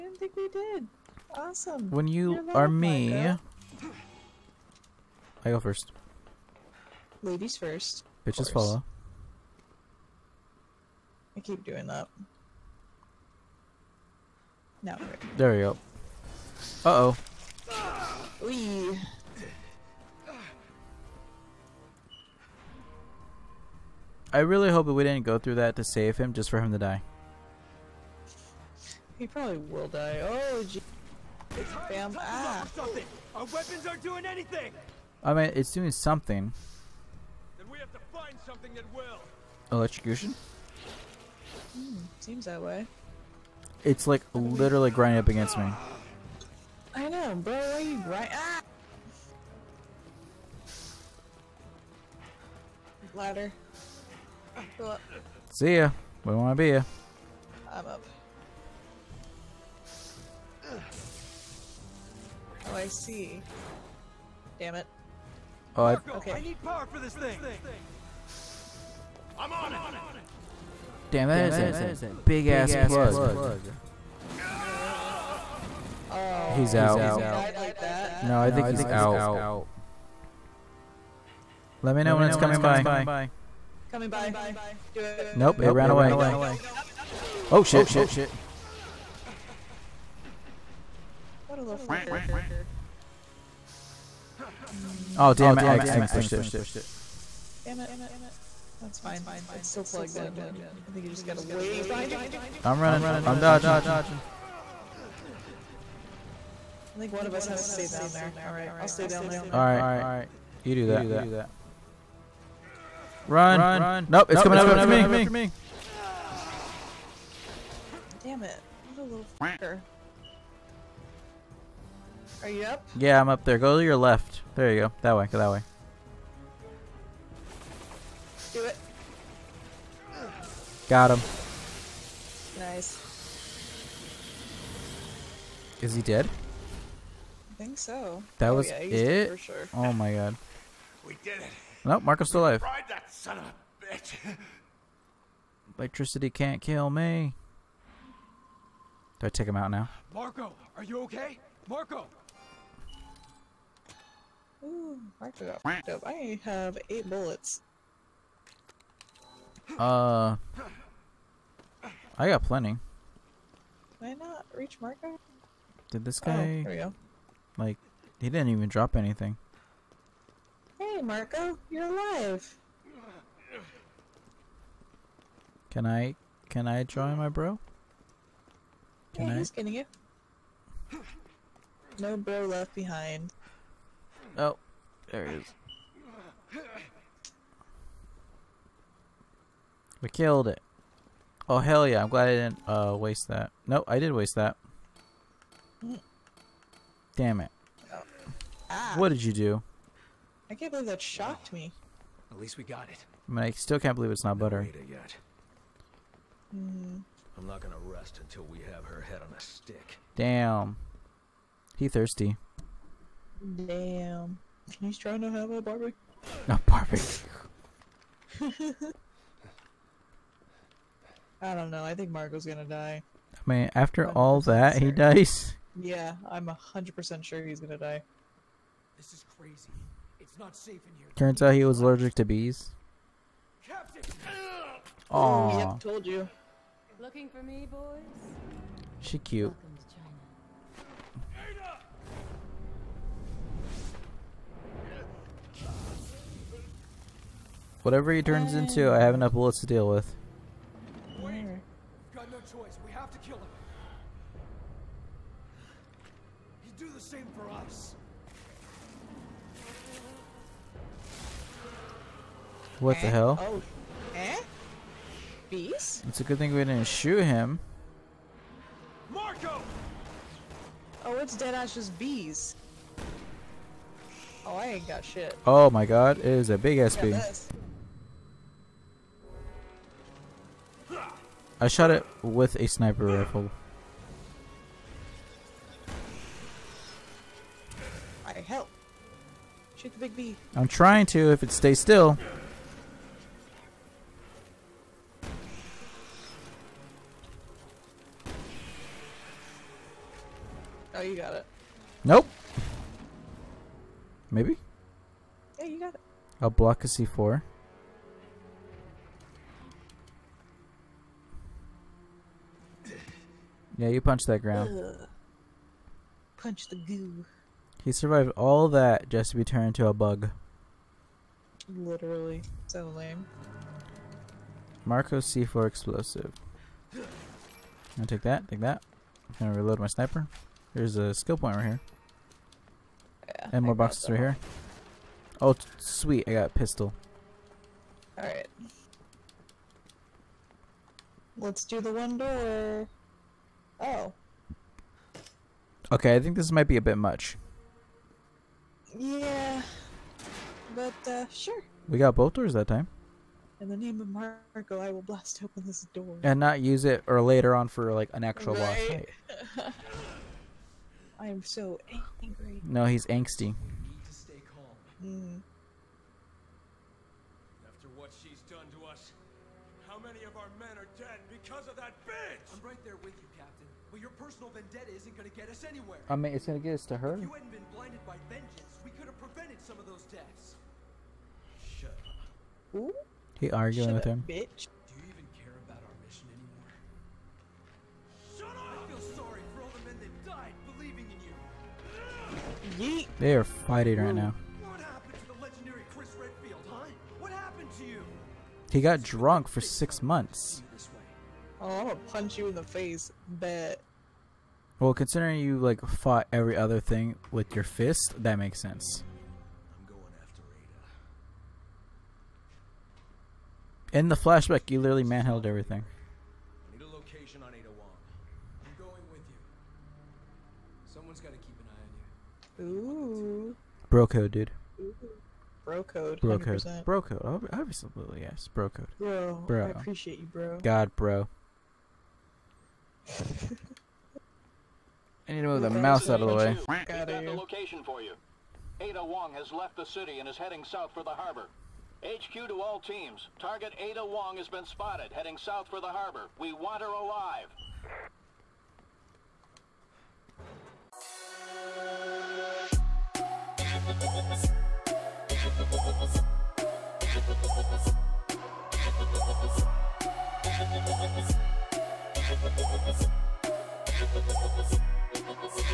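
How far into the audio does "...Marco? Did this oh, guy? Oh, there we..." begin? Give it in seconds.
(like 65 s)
164 s.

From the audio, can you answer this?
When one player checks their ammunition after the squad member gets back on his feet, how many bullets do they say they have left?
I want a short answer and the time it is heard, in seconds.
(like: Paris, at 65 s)
8, at 156 s.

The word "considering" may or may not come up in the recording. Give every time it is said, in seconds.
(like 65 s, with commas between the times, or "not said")
404 s.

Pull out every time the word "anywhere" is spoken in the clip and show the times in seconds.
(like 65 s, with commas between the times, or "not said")
375 s.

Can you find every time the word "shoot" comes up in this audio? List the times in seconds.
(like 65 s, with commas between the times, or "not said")
266 s, 289 s.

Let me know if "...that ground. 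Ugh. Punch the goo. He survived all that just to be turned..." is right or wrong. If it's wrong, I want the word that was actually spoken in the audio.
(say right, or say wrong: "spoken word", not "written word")
right.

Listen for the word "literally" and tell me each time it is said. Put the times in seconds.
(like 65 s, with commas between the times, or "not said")
44 s, 321 s, 414 s.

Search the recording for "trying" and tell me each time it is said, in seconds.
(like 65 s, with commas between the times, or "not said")
214 s, 290 s.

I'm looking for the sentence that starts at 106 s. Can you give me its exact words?
I think one of us has to stay down there.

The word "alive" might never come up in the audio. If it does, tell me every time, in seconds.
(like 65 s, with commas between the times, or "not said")
142 s, 171 s, 446 s.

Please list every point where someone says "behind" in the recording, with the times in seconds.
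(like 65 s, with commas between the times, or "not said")
101 s, 182 s.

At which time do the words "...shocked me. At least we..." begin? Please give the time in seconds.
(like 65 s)
201 s.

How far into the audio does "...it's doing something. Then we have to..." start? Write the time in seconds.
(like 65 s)
35 s.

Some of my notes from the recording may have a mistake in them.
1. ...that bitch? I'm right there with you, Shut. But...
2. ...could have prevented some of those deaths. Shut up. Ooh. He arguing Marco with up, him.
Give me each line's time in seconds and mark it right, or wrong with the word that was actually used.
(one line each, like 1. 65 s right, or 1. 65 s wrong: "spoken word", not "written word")
1. 371 s wrong: "Captain", not "Shut"
2. 378 s wrong: "Shut", not "Marco".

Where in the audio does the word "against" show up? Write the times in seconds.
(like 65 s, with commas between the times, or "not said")
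45 s.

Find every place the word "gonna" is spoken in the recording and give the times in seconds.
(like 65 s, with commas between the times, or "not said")
207 s, 222 s, 227 s, 329 s, 401 s.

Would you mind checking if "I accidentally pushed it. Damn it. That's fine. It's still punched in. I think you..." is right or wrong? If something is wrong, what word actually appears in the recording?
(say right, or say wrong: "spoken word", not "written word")
wrong: "plugged", not "punched".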